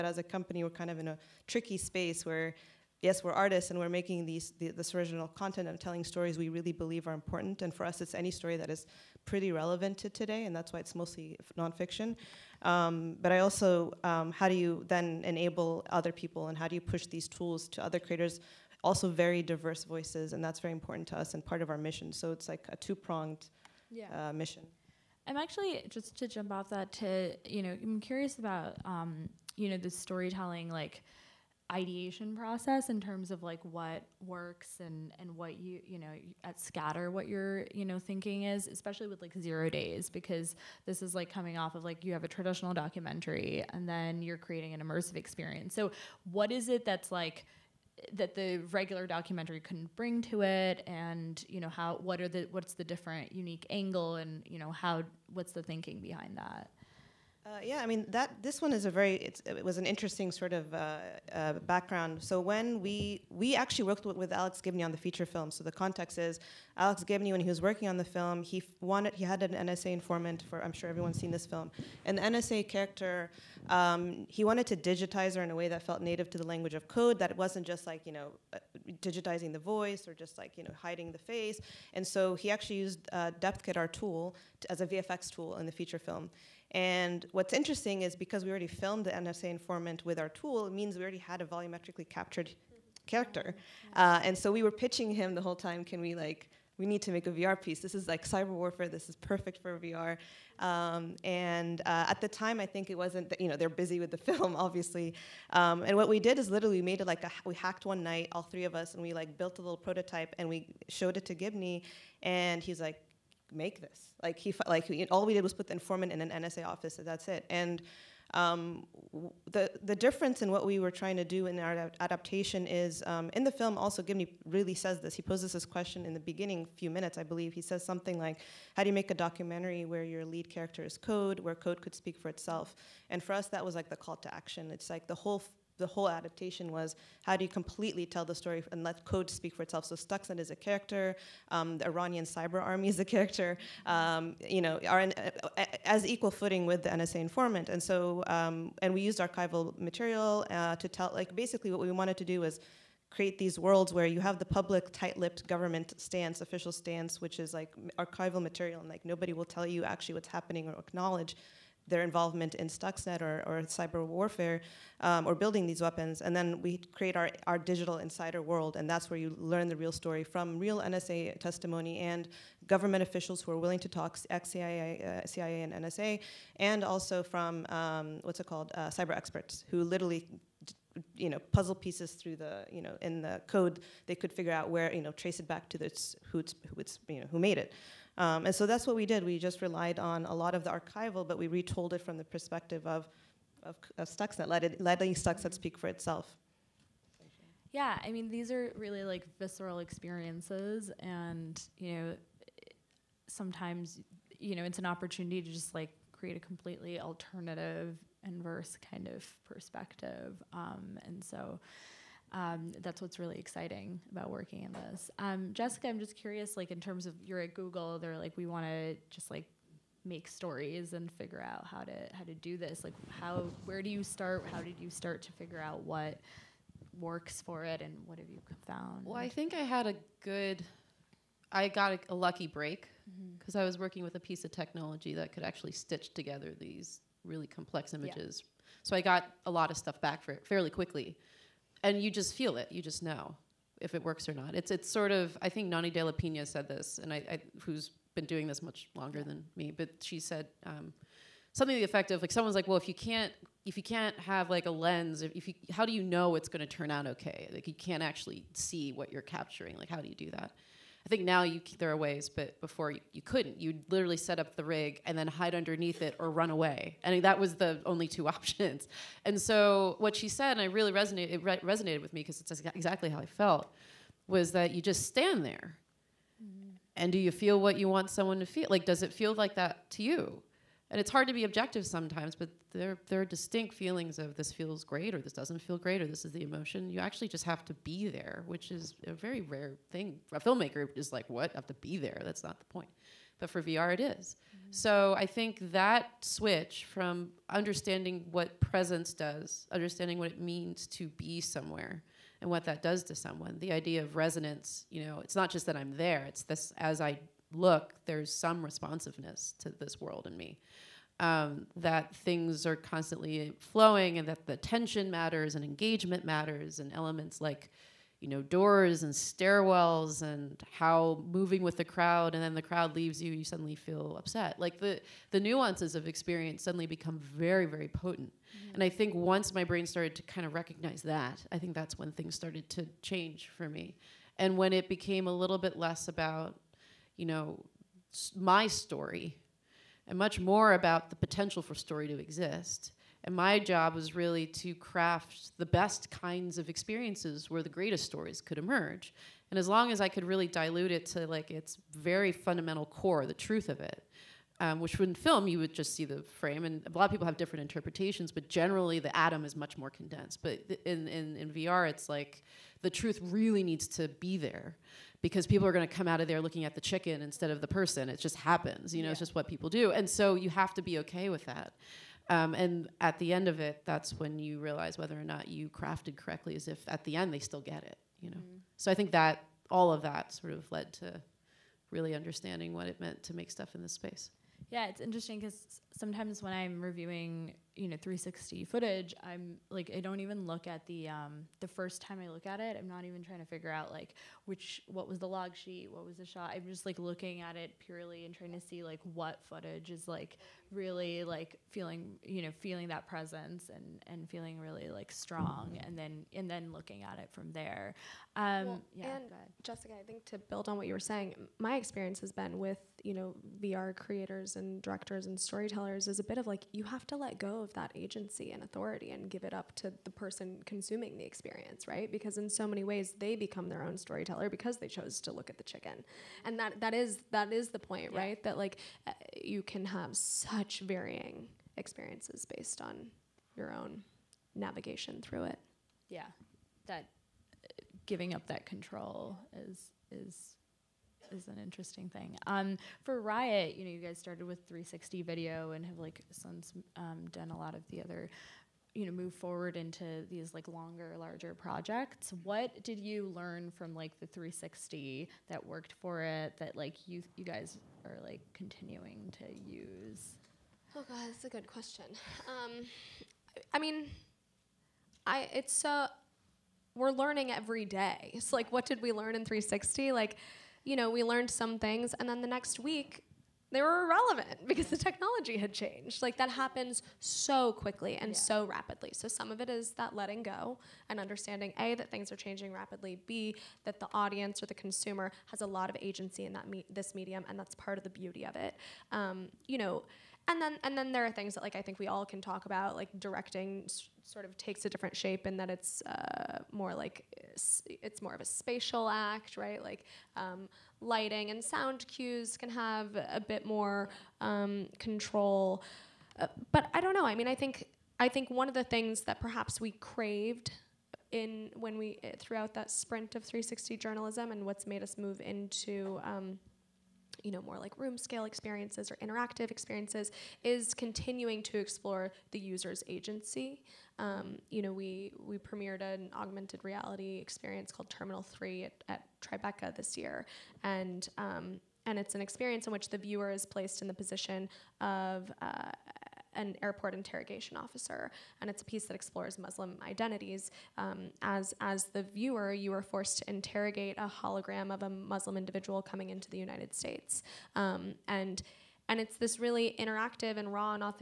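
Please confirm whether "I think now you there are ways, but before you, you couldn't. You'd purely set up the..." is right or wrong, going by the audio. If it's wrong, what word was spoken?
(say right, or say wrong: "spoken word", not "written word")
wrong: "literally", not "purely".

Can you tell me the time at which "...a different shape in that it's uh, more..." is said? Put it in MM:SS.
08:14.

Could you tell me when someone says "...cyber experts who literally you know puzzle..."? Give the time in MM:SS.
02:58.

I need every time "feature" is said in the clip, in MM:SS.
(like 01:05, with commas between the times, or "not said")
01:04, 01:25.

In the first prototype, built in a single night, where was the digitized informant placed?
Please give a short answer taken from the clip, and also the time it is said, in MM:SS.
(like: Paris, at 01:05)
An NSA office, at 01:56.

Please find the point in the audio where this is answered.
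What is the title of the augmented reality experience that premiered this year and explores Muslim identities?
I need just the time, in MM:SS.
08:48.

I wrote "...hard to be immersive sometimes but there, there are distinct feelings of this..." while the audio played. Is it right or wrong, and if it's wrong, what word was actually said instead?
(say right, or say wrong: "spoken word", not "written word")
wrong: "objective", not "immersive".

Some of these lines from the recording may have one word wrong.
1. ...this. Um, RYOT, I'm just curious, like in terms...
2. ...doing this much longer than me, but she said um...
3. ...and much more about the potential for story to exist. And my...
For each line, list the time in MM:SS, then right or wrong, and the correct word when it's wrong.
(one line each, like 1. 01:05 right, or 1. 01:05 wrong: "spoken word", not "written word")
1. 03:34 wrong: "Jessica", not "RYOT"
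2. 04:08 right
3. 05:40 right.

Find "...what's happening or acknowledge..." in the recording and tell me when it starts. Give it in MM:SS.
02:40.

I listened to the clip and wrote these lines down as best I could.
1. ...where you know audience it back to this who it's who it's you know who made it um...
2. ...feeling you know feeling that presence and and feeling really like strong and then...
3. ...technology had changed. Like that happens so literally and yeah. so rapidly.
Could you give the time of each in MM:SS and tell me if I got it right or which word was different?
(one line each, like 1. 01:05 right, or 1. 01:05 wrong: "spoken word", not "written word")
1. 03:04 wrong: "trace", not "audience"
2. 06:41 right
3. 07:54 wrong: "quickly", not "literally".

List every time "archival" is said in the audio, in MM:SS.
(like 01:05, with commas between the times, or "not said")
02:29, 02:37, 03:10.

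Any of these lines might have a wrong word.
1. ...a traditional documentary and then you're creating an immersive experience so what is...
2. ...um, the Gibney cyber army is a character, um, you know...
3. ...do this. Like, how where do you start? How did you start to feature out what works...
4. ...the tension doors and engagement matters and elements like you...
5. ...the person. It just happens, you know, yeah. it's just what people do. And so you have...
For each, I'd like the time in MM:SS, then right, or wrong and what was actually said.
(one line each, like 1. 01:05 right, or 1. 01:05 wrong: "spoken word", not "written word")
1. 00:42 right
2. 02:21 wrong: "Iranian", not "Gibney"
3. 03:42 wrong: "figure", not "feature"
4. 05:14 wrong: "matters", not "doors"
5. 06:07 right.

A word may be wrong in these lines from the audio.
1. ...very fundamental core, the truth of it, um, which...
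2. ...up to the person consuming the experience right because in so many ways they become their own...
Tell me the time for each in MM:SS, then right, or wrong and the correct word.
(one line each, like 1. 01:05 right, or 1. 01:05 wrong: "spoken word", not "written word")
1. 05:51 right
2. 06:59 right.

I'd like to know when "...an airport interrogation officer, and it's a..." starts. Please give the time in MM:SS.
08:56.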